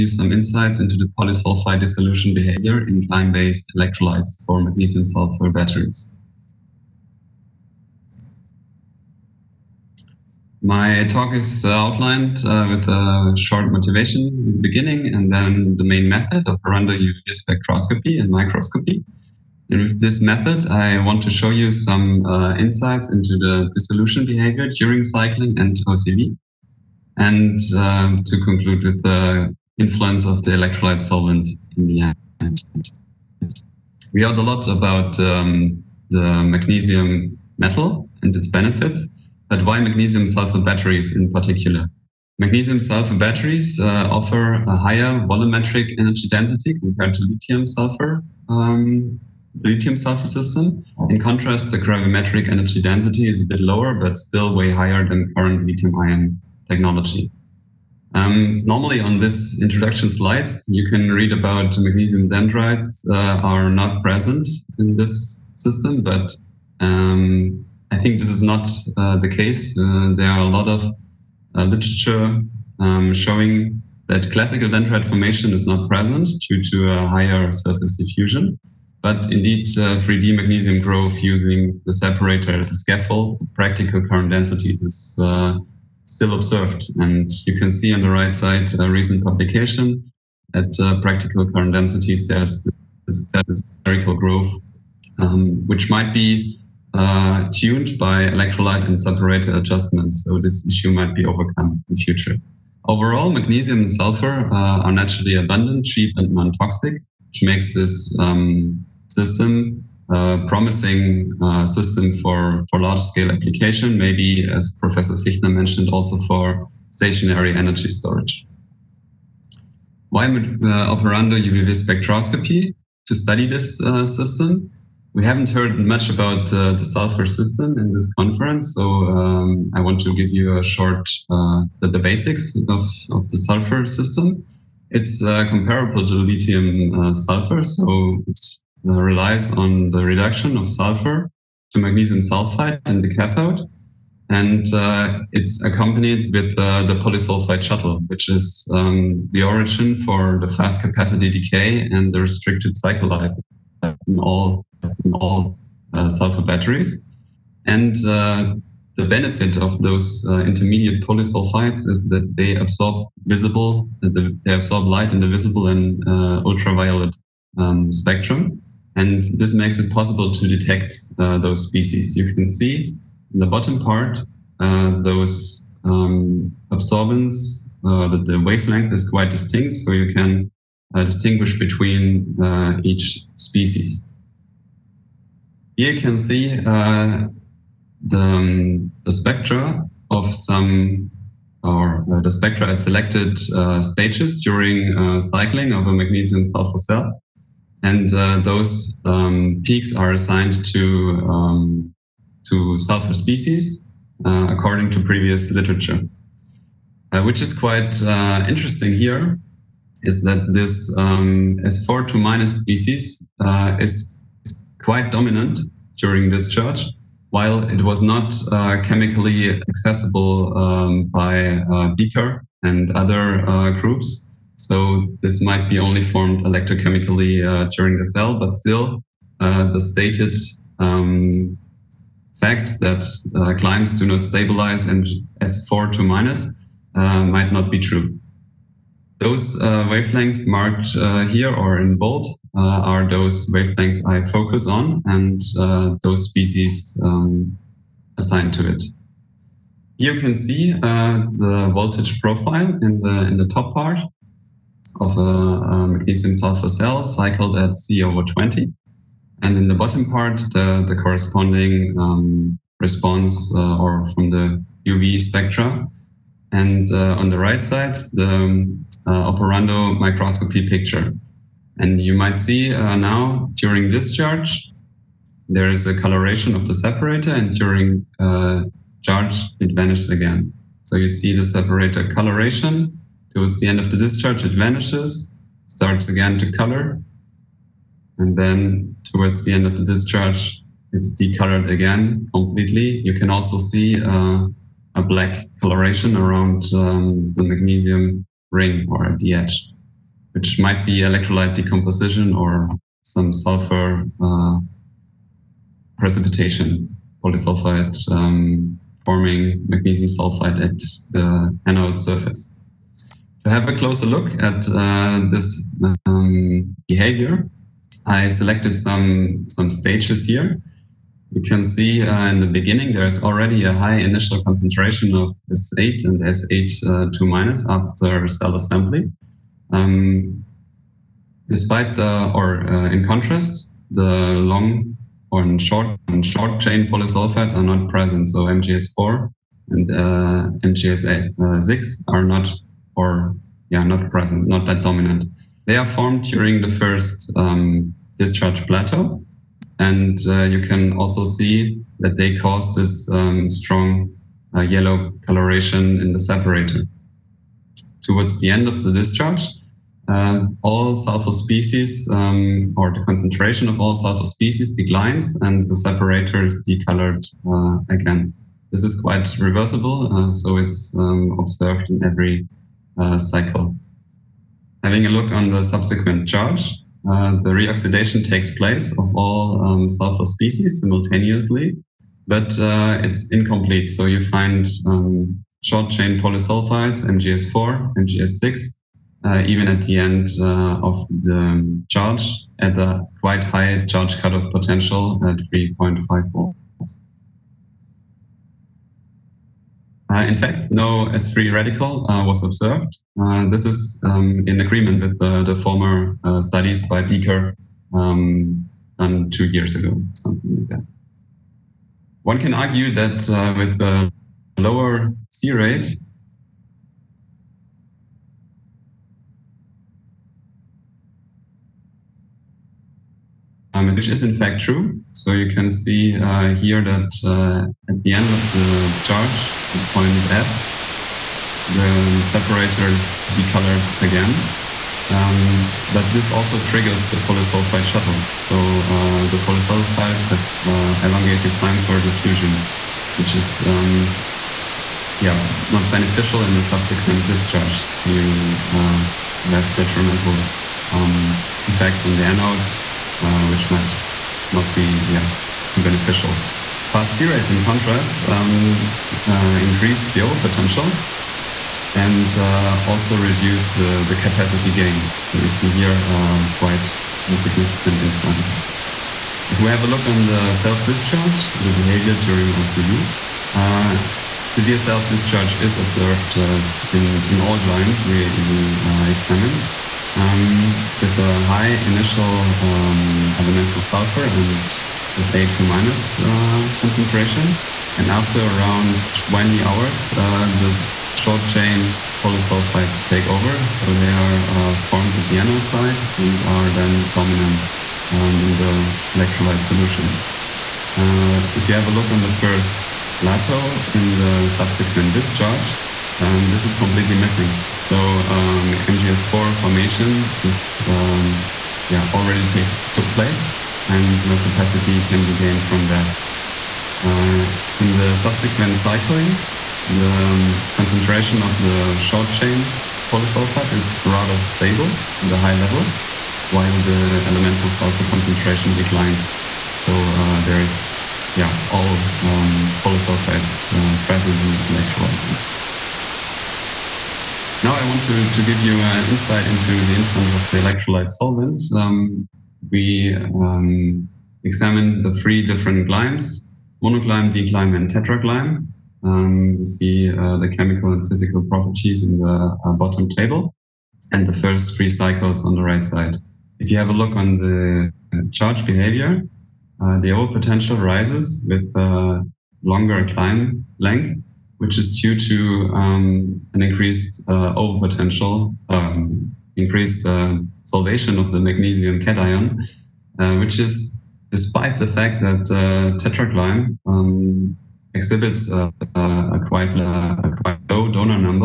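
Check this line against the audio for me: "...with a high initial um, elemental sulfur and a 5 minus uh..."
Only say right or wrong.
wrong.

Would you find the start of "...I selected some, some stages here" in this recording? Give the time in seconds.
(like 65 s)
318 s.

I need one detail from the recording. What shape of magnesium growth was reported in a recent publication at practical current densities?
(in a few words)
spherical.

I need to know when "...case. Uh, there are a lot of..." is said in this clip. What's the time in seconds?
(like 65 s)
69 s.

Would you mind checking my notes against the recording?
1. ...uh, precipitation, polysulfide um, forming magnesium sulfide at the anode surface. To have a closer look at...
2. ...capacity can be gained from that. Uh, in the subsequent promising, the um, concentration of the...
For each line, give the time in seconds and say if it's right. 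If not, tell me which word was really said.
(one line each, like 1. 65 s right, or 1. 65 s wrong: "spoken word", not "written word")
1. 304 s right
2. 514 s wrong: "cycling", not "promising".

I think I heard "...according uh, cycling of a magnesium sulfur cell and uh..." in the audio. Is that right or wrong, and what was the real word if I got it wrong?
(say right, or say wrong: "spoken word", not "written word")
wrong: "during", not "according".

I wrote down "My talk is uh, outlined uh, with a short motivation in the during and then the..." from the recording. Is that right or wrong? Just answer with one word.
wrong.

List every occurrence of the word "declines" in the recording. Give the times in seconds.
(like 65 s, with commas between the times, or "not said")
364 s, 528 s.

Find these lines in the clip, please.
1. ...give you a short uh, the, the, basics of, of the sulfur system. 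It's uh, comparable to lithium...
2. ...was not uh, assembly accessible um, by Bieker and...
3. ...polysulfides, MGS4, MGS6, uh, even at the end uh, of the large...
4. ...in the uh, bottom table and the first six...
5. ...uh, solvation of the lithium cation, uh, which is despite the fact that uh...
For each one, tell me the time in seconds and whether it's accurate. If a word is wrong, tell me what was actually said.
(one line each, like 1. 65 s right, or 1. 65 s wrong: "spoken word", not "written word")
1. 130 s right
2. 217 s wrong: "chemically", not "assembly"
3. 386 s wrong: "charge", not "large"
4. 552 s wrong: "three", not "six"
5. 570 s wrong: "magnesium", not "lithium".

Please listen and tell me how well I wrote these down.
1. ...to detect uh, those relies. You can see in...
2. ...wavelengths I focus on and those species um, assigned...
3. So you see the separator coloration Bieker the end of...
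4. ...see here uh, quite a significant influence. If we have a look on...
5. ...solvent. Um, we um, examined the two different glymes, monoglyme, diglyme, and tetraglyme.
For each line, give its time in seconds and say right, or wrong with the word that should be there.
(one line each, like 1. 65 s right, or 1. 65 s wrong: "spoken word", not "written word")
1. 170 s wrong: "species", not "relies"
2. 243 s right
3. 280 s wrong: "Towards", not "Bieker"
4. 465 s right
5. 541 s wrong: "three", not "two".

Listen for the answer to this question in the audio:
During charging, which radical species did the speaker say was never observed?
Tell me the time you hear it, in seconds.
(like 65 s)
401 s.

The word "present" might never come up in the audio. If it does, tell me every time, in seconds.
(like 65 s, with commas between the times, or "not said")
64 s, 75 s, 337 s, 344 s, 534 s.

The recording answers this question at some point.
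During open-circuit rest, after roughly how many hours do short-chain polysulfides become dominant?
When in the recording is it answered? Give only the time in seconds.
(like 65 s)
489 s.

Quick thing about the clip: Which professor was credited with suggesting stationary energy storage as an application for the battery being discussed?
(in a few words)
Professor Fichtner.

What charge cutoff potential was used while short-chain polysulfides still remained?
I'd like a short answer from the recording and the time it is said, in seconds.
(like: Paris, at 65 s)
3.54, at 395 s.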